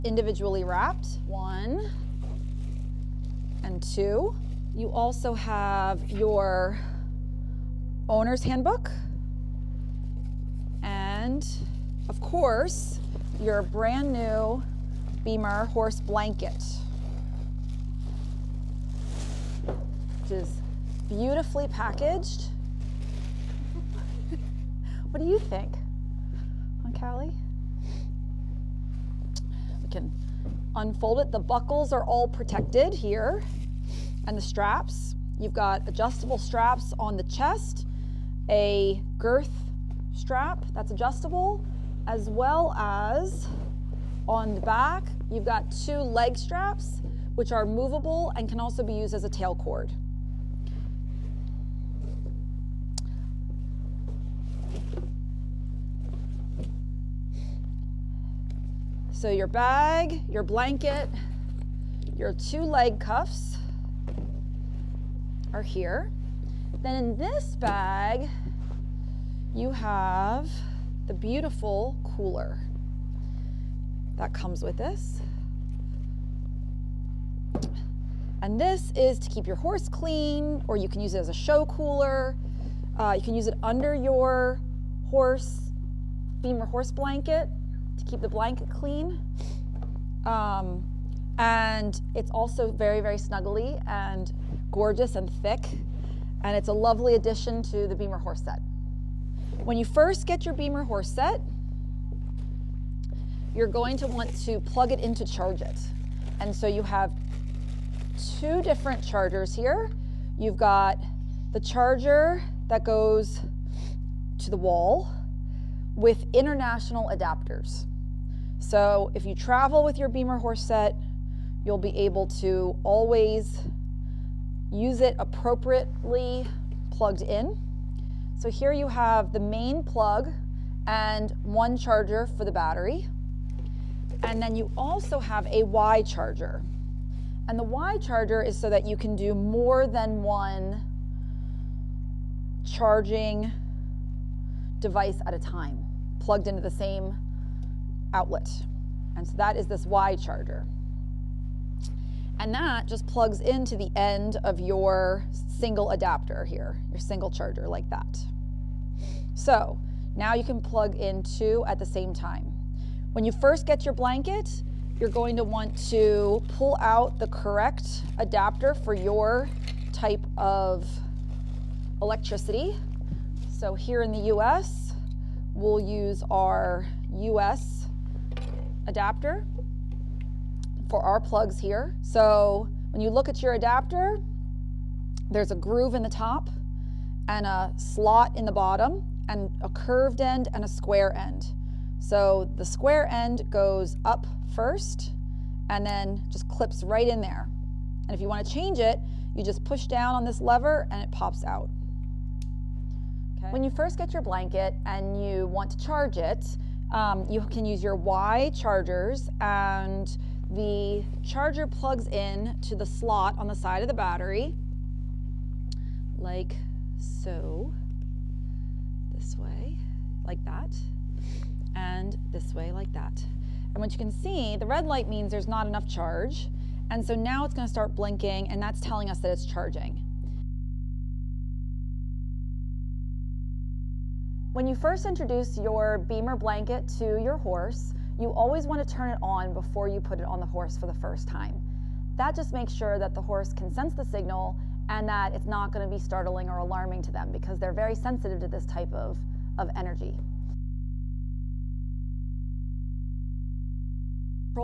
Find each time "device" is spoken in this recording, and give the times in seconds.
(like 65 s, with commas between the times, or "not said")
144 s.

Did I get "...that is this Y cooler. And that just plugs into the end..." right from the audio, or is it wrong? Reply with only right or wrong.
wrong.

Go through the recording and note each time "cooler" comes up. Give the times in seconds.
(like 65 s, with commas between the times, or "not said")
72 s, 81 s.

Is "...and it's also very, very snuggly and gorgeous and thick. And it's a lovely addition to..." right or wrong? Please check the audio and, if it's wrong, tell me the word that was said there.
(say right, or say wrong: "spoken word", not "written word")
right.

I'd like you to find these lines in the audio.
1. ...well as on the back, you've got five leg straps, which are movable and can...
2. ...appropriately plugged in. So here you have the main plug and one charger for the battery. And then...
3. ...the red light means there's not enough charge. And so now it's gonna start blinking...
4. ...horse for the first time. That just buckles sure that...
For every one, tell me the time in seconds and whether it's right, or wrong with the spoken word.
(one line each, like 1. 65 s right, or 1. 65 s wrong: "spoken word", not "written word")
1. 42 s wrong: "two", not "five"
2. 125 s right
3. 224 s right
4. 240 s wrong: "makes", not "buckles".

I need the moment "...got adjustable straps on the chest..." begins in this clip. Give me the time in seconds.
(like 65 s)
35 s.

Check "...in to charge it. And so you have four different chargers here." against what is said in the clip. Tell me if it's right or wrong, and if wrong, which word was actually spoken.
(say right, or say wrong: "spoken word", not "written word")
wrong: "two", not "four".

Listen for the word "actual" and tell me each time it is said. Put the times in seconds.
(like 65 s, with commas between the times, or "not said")
not said.